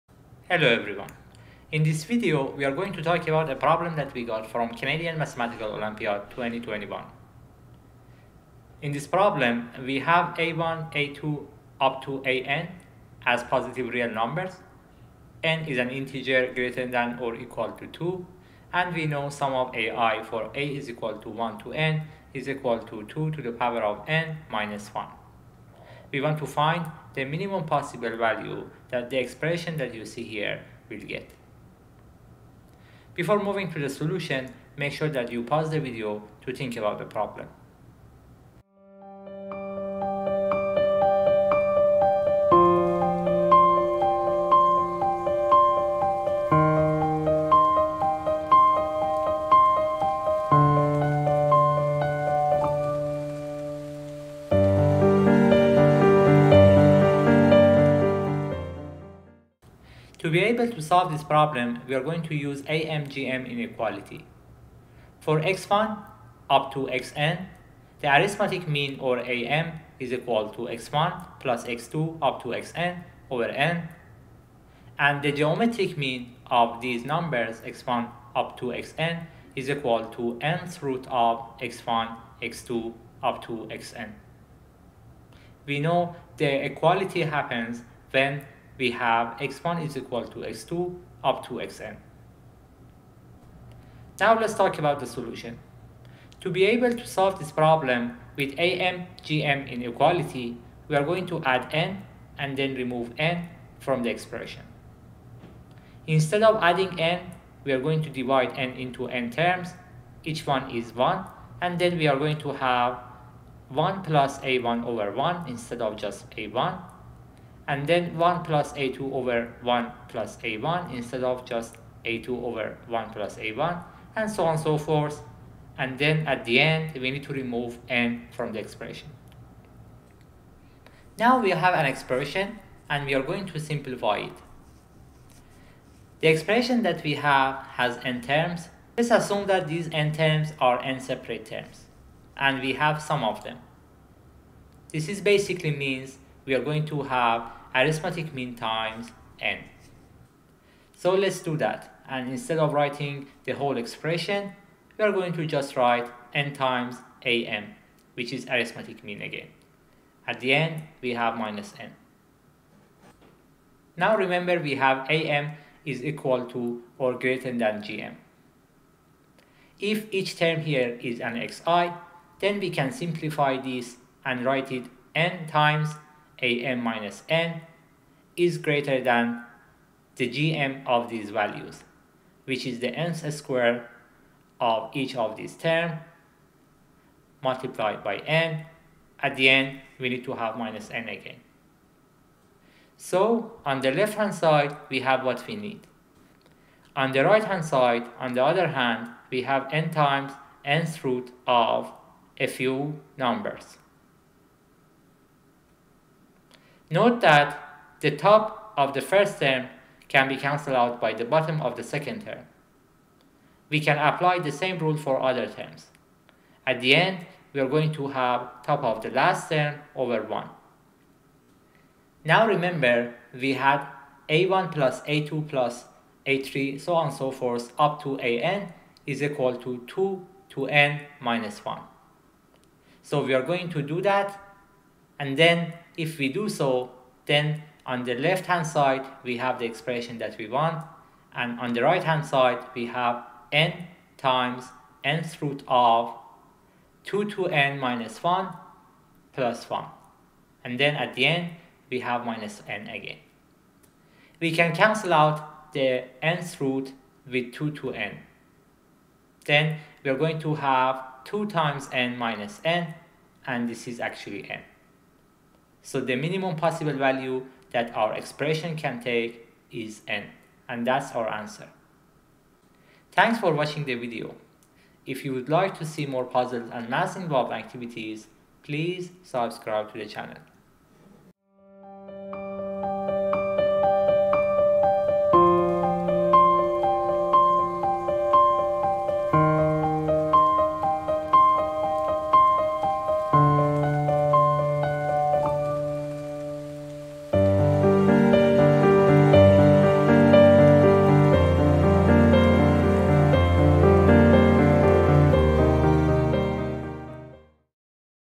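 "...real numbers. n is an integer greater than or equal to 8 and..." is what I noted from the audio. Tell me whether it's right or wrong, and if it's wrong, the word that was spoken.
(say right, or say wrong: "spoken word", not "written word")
wrong: "2", not "8".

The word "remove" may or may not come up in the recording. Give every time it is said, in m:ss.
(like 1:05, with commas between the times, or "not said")
1:42, 2:07.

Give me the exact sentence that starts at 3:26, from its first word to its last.
Note that the top of the first term can be cancelled out by the bottom of the second term.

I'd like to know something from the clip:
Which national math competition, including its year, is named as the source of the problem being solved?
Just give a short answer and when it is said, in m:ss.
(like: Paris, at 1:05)
Canadian Mathematical Olympiad 2021, at 0:04.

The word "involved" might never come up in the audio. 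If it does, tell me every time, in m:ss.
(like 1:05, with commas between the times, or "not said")
4:37.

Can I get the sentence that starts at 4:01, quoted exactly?
And on the right hand side, we have n times nth root of 2 to n minus 1 plus 1.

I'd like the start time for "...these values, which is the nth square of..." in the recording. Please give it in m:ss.
3:01.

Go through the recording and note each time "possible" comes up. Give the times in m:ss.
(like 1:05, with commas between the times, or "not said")
0:27, 4:26.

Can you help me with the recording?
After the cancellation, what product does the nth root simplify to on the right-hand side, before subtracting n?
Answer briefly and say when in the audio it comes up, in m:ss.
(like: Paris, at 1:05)
2 times n, at 4:21.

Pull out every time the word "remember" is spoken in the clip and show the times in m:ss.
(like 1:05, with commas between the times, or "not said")
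2:44, 3:42.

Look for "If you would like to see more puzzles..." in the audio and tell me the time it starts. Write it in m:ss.
4:35.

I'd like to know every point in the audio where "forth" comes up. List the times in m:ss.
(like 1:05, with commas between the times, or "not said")
2:04, 3:47.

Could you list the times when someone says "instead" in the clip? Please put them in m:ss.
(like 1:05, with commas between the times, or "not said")
1:46, 1:55, 2:00, 2:32.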